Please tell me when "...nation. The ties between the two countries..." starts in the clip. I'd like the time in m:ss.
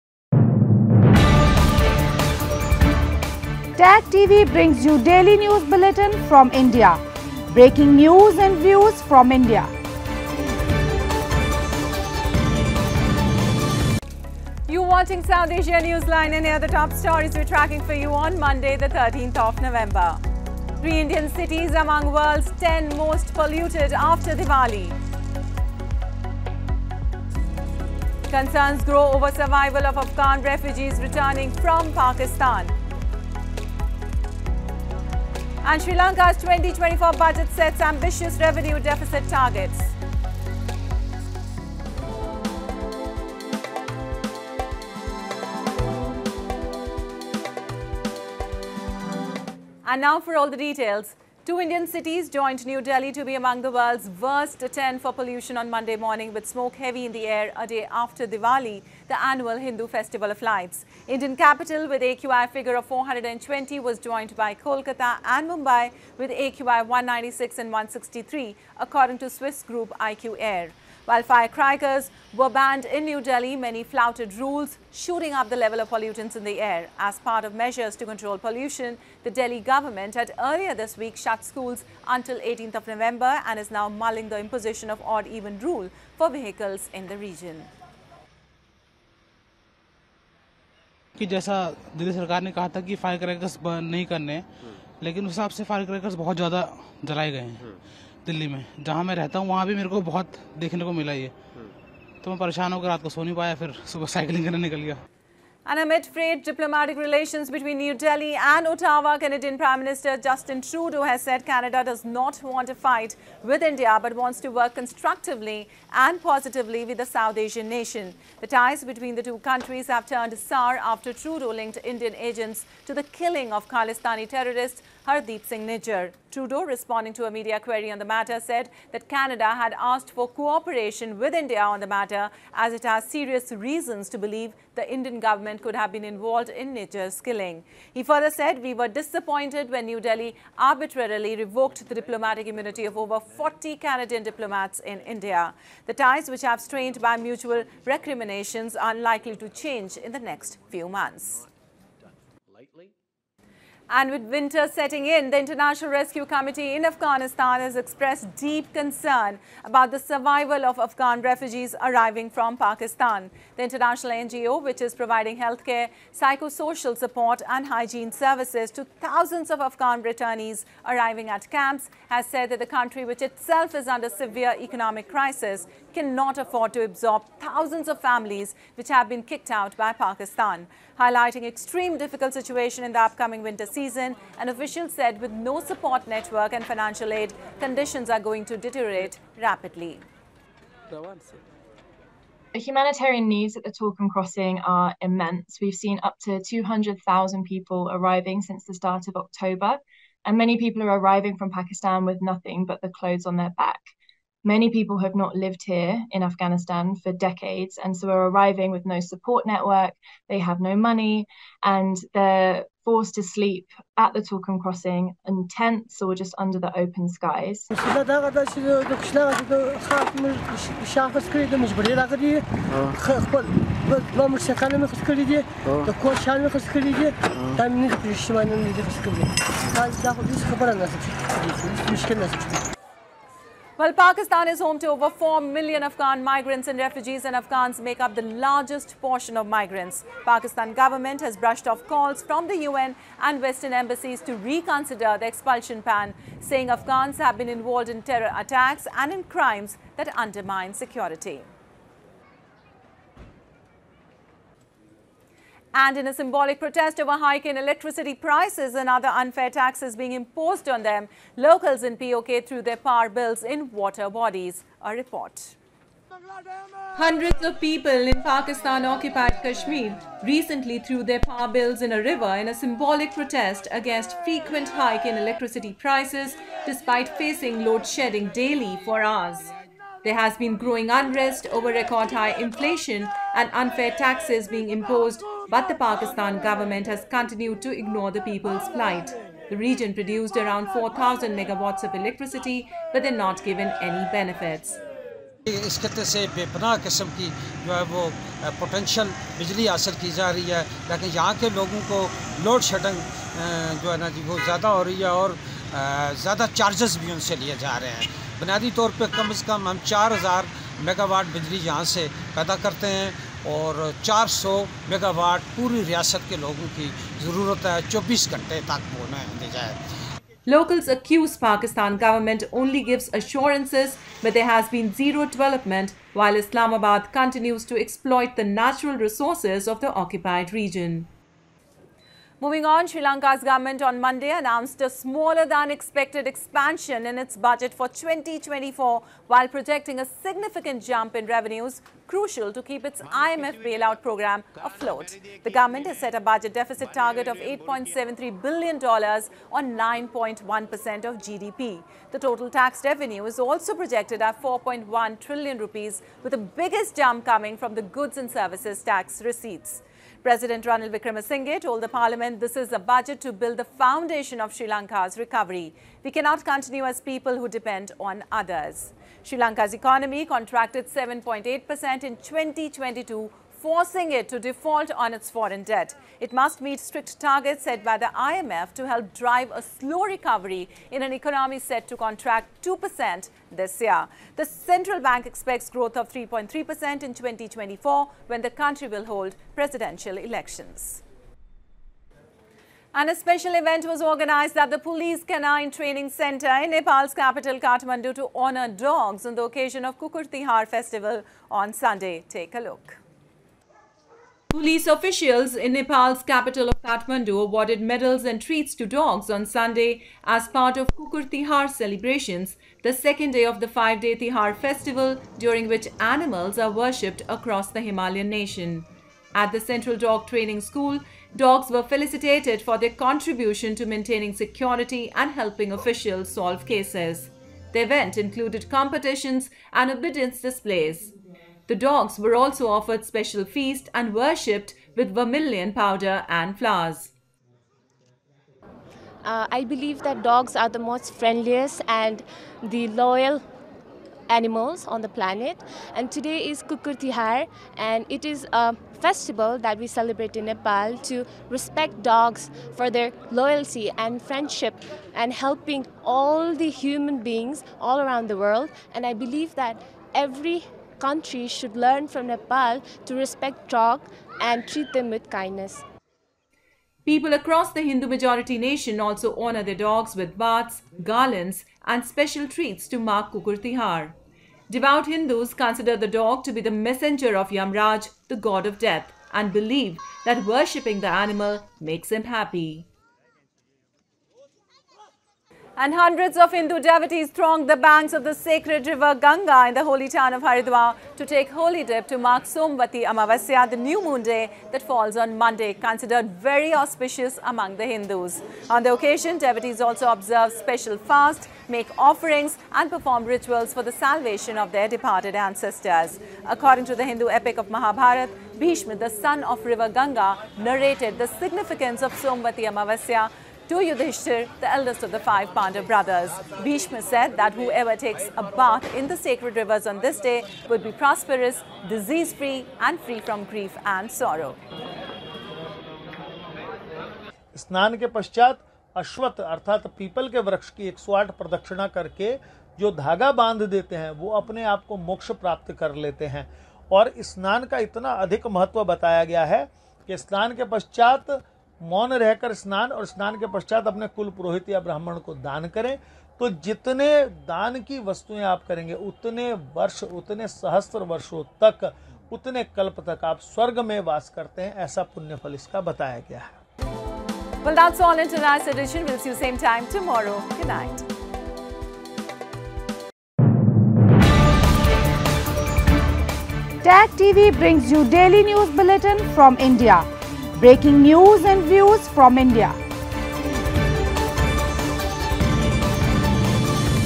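1:57.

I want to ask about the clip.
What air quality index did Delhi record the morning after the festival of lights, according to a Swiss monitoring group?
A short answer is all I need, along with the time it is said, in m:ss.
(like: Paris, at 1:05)
420, at 1:02.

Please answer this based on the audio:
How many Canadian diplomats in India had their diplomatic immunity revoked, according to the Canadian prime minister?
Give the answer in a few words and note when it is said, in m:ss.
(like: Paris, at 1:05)
over 40, at 2:22.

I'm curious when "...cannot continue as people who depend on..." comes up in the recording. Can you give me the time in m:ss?
6:06.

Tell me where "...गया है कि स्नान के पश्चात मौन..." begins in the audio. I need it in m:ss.
8:59.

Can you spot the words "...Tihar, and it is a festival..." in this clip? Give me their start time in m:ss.
7:26.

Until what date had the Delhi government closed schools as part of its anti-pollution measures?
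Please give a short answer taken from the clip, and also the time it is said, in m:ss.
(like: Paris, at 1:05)
18th of November, at 1:22.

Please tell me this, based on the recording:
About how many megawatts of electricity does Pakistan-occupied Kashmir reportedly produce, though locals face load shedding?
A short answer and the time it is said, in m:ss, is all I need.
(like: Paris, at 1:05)
4,000 megawatts, at 4:50.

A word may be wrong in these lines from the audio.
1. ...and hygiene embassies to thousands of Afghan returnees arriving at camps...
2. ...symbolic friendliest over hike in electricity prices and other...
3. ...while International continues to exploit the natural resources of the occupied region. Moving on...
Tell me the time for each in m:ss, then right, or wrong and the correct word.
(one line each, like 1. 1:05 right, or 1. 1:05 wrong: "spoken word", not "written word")
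1. 2:47 wrong: "services", not "embassies"
2. 4:16 wrong: "protest", not "friendliest"
3. 5:26 wrong: "Islamabad", not "International".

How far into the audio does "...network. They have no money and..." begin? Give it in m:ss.
3:29.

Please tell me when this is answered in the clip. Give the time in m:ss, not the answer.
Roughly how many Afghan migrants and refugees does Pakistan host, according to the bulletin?
3:54.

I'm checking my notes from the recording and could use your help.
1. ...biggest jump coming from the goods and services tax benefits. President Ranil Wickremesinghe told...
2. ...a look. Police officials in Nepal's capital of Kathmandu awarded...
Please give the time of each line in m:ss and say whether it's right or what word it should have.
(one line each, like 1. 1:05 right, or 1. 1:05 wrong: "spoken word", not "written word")
1. 5:56 wrong: "receipts", not "benefits"
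2. 6:42 right.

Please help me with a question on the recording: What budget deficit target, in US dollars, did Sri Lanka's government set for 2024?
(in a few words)
$8.73 billion.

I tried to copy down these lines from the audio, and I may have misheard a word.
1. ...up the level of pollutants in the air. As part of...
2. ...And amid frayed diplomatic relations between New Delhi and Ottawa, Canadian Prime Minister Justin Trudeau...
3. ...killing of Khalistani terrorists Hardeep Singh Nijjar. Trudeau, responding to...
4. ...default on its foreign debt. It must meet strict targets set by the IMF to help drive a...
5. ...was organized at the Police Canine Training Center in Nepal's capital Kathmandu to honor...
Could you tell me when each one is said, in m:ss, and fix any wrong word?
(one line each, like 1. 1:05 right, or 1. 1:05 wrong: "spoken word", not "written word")
1. 1:15 right
2. 1:45 right
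3. 2:03 right
4. 6:14 right
5. 6:33 right.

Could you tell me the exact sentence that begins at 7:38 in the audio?
And I believe that every countries should learn from Nepal to respect dog and treat them with kindness.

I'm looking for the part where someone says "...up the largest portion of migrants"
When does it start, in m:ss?
3:57.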